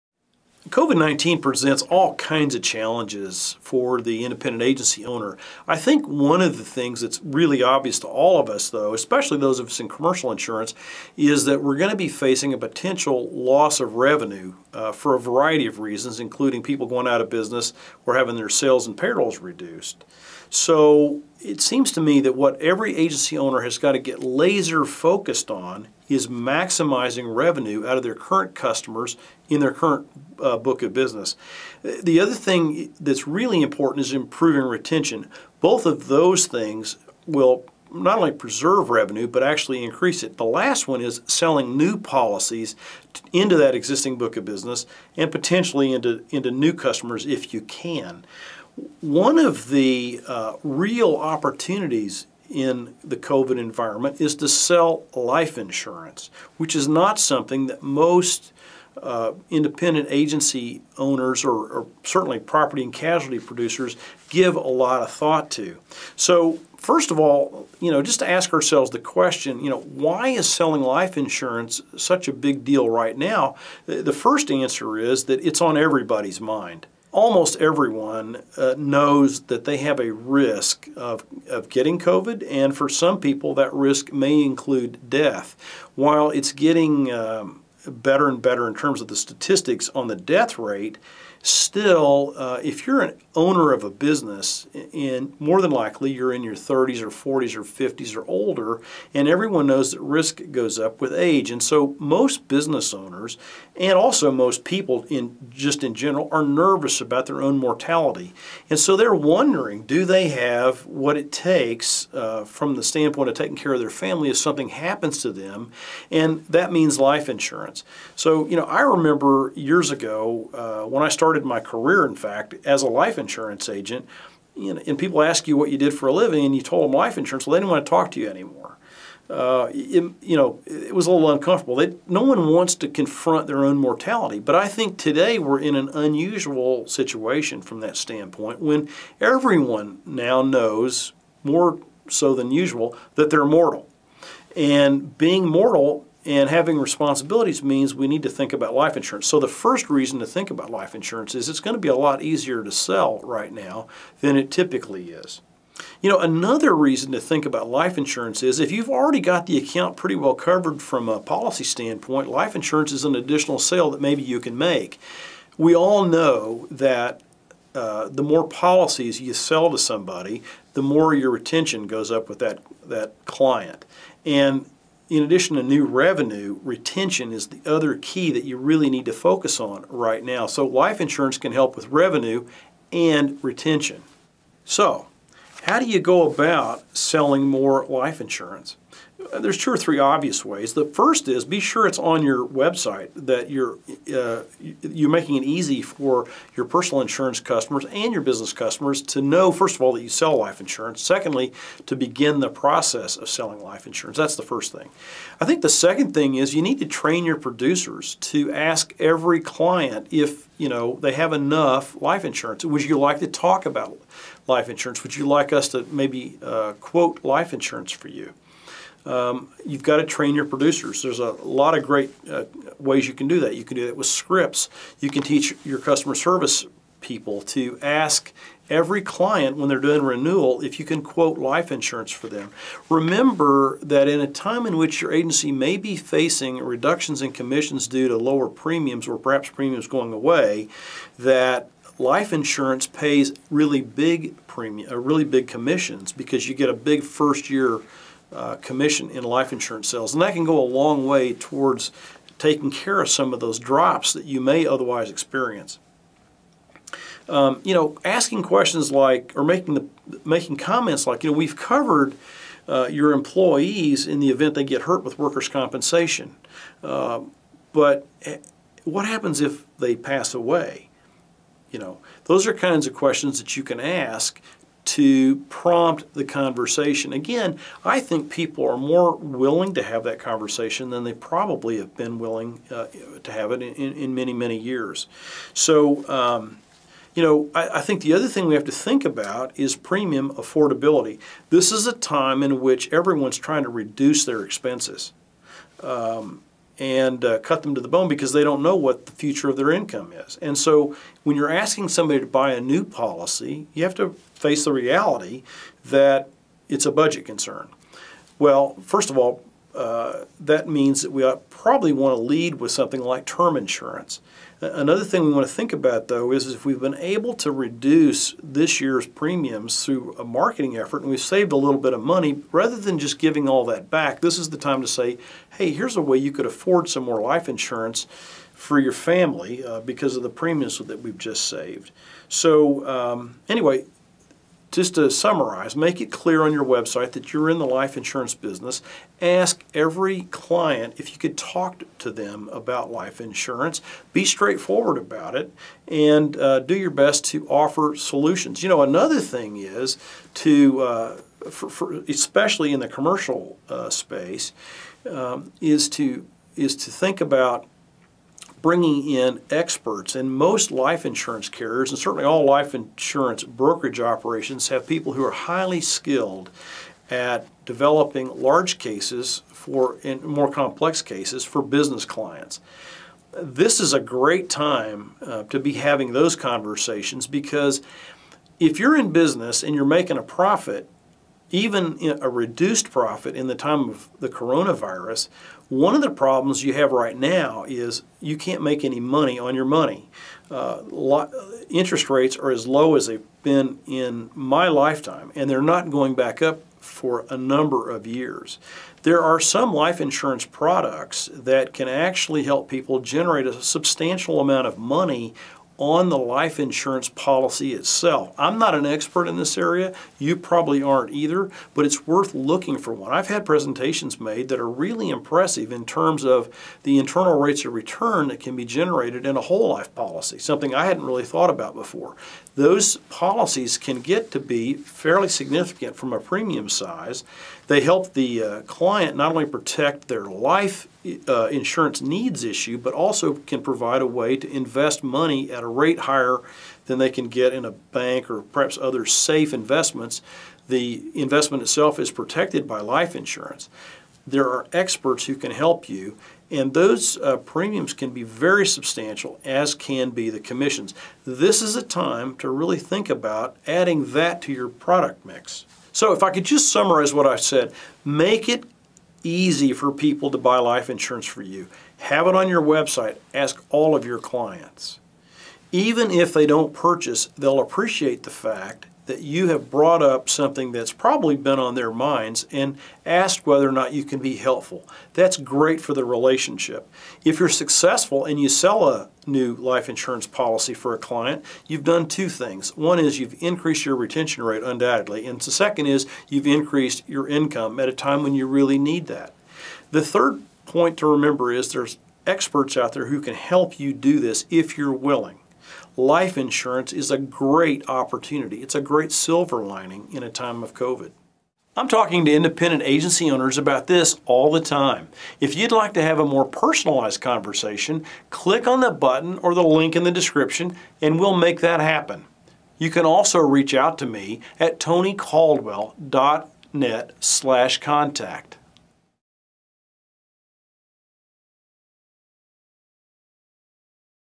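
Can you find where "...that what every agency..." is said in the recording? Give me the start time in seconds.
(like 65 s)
22 s.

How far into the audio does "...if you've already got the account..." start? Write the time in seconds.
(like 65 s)
158 s.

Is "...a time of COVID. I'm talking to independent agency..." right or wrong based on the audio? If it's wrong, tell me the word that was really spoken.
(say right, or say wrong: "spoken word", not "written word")
right.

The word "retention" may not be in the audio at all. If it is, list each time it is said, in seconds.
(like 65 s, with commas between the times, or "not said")
34 s, 171 s, 176 s, 183 s, 483 s.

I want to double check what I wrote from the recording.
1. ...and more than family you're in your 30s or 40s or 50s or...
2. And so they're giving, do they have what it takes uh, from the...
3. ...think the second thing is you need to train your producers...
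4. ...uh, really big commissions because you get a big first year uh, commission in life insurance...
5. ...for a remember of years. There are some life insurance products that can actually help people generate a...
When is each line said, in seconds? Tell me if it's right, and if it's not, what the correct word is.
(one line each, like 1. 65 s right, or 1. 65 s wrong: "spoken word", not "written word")
1. 94 s wrong: "likely", not "family"
2. 108 s wrong: "wondering", not "giving"
3. 205 s right
4. 244 s right
5. 396 s wrong: "number", not "remember".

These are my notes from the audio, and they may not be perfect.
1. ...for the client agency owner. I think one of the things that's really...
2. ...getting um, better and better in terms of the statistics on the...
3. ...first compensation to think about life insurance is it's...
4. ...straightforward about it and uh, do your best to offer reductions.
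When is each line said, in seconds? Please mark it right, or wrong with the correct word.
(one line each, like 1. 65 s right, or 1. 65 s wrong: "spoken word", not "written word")
1. 3 s wrong: "independent", not "client"
2. 86 s right
3. 149 s wrong: "reason", not "compensation"
4. 344 s wrong: "solutions", not "reductions".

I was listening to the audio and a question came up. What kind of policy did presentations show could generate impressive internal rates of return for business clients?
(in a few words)
Whole life policy.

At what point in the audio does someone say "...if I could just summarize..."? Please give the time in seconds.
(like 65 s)
456 s.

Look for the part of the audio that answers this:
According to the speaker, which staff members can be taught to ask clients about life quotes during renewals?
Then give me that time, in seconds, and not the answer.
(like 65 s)
225 s.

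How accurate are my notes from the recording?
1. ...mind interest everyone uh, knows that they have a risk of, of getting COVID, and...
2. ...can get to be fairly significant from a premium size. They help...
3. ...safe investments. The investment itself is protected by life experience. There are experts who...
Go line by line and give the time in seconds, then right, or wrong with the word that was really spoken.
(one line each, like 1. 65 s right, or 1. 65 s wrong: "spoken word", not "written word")
1. 76 s wrong: "almost", not "interest"
2. 423 s right
3. 439 s wrong: "insurance", not "experience".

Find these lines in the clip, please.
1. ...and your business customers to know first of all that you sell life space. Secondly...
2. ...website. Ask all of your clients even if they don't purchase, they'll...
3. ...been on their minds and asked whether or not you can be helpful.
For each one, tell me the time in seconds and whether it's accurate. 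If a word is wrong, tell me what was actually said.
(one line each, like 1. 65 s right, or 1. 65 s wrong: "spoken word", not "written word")
1. 197 s wrong: "insurance", not "space"
2. 462 s right
3. 471 s right.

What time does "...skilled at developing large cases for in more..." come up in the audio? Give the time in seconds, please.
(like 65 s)
365 s.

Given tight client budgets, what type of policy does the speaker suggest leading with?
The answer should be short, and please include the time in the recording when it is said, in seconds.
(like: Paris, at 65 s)
Term insurance, at 313 s.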